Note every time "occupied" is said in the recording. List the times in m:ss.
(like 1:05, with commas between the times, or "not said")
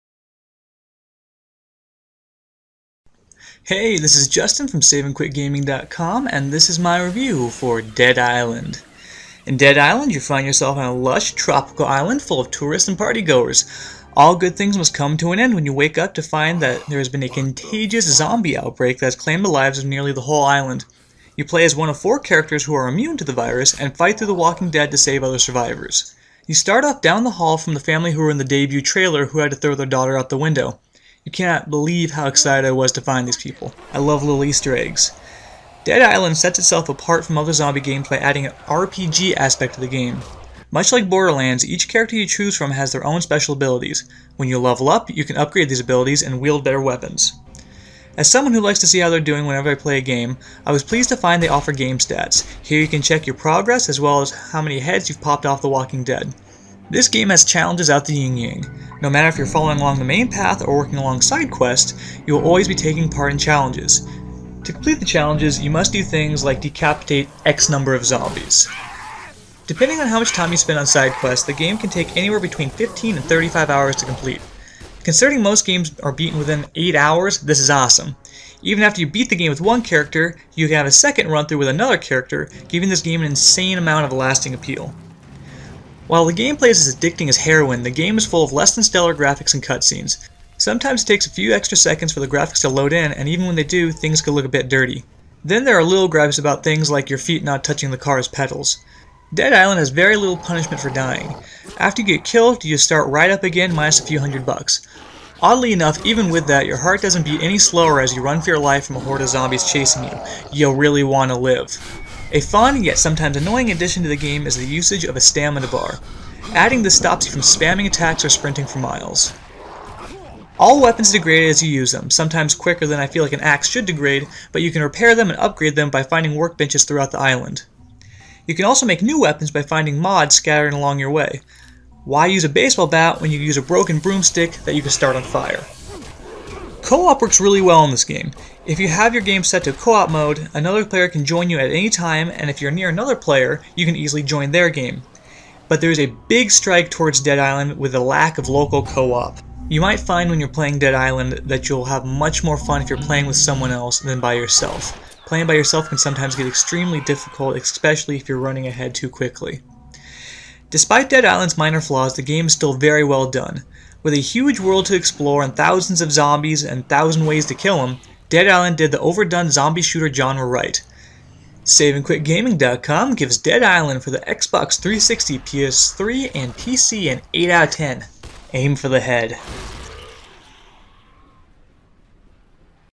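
not said.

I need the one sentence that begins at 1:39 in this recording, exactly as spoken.
Dead Island has very little punishment for dying.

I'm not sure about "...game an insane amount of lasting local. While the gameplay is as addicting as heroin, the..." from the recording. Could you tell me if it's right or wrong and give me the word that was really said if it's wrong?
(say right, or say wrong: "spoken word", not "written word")
wrong: "appeal", not "local".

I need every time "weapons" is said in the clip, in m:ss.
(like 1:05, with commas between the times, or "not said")
0:46, 2:00, 2:09.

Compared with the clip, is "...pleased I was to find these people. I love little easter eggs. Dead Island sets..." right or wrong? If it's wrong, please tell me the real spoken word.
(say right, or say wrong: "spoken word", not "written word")
wrong: "excited", not "pleased".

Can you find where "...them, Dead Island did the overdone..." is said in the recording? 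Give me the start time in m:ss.
2:47.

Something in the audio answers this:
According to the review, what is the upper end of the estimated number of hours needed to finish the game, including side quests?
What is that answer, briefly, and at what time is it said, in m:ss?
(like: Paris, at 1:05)
35 hours, at 1:13.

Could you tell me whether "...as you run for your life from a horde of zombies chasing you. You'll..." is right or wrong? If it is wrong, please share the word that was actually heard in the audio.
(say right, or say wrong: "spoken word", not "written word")
right.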